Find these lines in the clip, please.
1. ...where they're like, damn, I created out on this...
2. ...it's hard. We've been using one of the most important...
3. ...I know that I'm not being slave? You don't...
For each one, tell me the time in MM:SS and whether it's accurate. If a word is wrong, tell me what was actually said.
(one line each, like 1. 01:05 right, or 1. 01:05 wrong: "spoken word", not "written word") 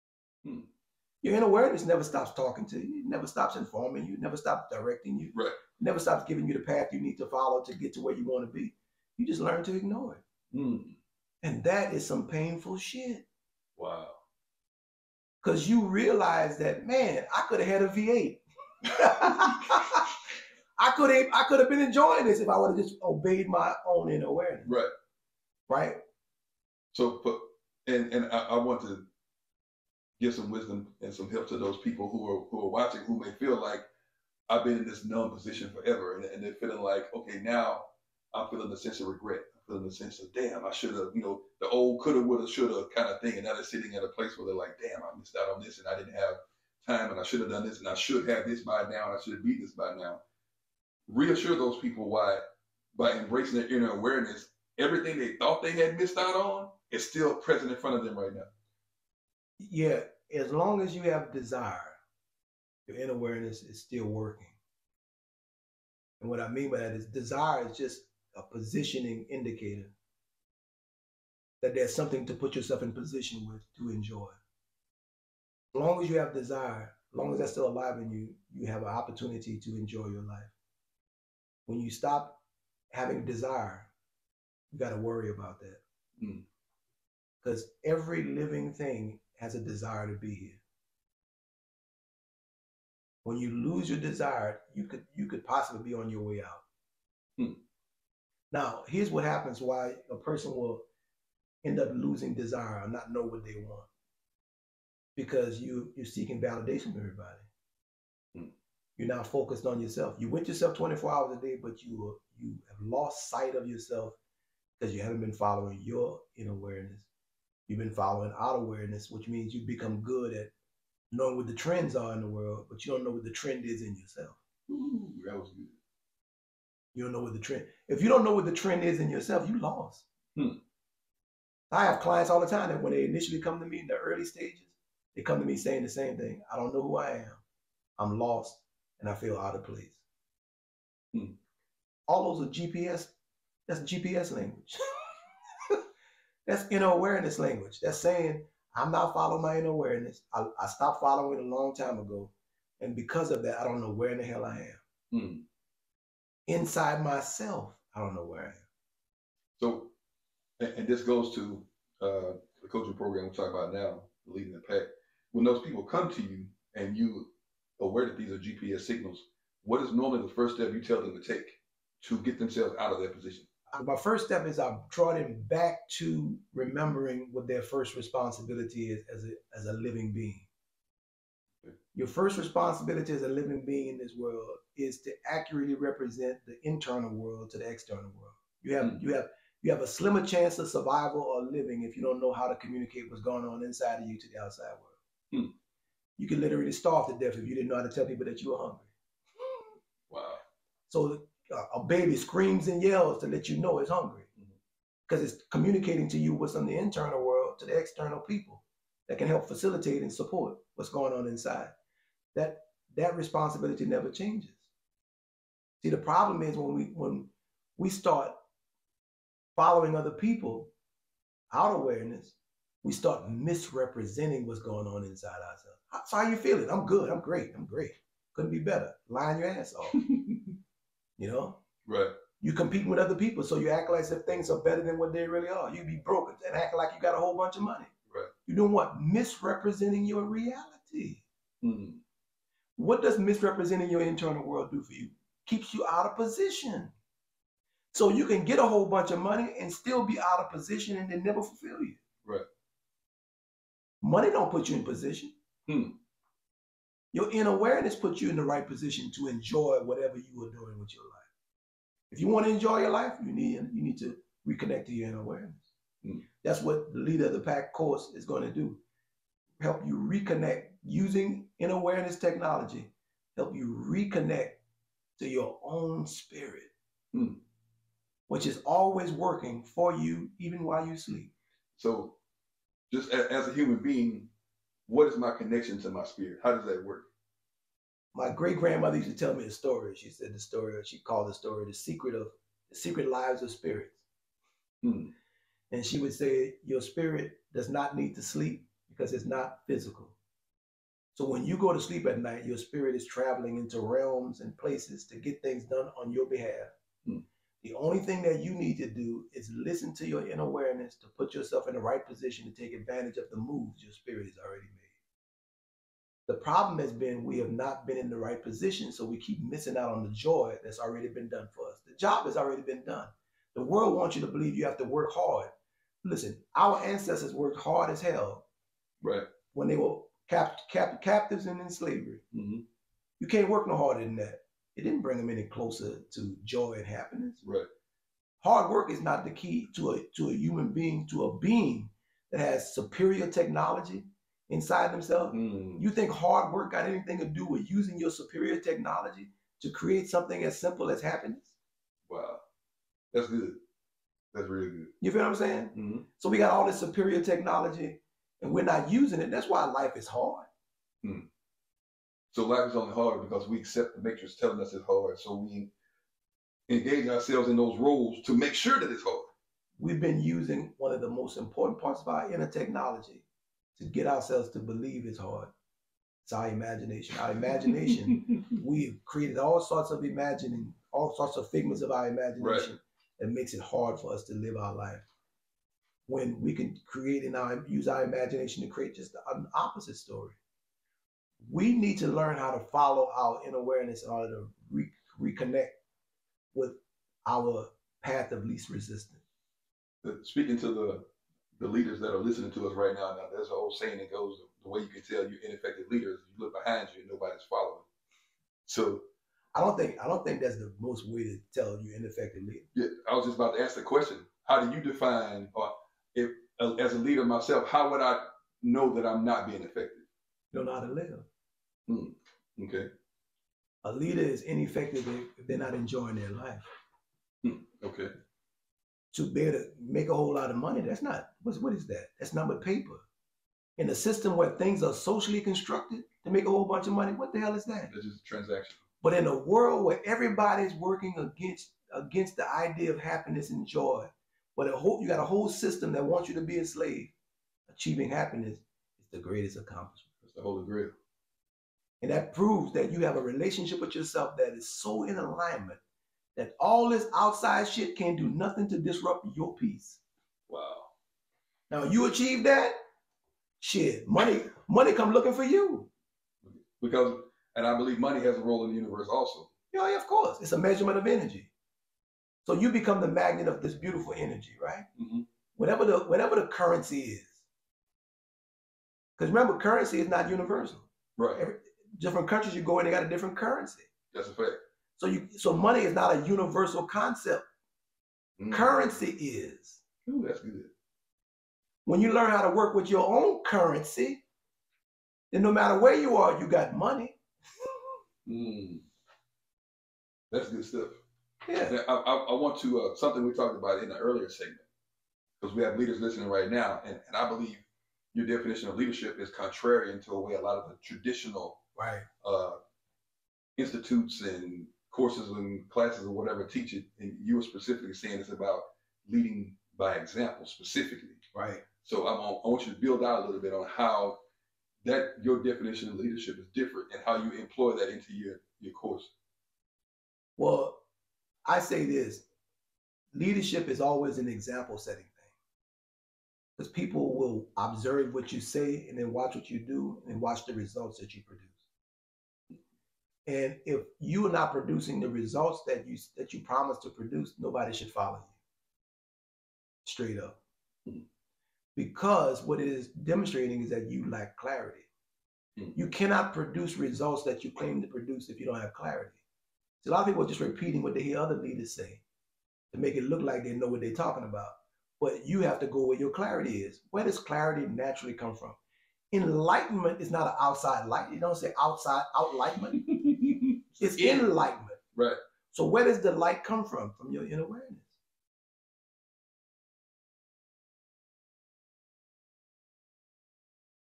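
1. 00:44 wrong: "missed", not "created"
2. 06:08 right
3. 06:58 wrong: "effective", not "slave".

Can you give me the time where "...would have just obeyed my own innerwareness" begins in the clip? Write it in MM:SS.
00:22.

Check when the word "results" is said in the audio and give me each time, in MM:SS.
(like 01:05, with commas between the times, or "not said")
09:00, 09:05, 09:16.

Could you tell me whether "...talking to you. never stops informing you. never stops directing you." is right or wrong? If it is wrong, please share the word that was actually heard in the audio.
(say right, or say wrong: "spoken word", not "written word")
right.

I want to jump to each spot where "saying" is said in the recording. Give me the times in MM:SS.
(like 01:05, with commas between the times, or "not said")
02:15, 02:27, 05:55, 06:43, 08:37.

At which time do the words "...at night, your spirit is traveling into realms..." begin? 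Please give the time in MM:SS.
05:02.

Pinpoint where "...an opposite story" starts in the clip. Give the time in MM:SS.
06:29.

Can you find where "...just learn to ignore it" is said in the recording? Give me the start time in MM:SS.
00:09.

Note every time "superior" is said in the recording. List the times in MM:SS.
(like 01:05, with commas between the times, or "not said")
05:42, 05:48, 05:56.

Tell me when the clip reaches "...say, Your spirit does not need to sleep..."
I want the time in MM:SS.
04:56.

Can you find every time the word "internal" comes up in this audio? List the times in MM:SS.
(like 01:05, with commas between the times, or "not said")
03:06, 03:26, 04:04.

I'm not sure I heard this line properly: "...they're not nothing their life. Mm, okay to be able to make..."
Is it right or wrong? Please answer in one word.
wrong.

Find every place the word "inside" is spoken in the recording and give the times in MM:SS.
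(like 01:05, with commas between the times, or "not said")
02:36, 03:13, 03:31, 03:45, 05:44.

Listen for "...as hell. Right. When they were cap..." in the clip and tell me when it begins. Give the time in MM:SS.
05:27.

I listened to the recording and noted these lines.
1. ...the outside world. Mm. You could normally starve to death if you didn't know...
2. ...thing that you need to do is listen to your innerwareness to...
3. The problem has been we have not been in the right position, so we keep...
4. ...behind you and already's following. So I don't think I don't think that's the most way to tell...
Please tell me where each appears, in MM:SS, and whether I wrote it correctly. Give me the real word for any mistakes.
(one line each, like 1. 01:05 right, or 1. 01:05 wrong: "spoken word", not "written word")
1. 03:14 wrong: "literally", not "normally"
2. 05:07 right
3. 05:16 right
4. 06:46 wrong: "nobody", not "already".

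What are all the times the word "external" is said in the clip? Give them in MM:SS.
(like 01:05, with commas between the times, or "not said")
03:07, 03:27.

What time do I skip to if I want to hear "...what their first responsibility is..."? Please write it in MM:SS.
02:57.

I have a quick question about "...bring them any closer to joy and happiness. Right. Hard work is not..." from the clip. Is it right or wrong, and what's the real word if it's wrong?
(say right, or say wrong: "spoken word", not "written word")
right.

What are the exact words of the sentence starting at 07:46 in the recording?
Because, and I believe money has a role in the universe also.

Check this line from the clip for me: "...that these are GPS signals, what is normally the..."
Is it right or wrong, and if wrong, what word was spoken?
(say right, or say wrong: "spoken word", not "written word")
right.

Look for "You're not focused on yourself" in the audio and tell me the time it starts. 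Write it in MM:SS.
01:48.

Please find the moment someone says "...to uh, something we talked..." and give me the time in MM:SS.
08:22.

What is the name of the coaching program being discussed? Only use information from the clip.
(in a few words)
Leading the pack.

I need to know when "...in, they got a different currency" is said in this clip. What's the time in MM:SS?
08:02.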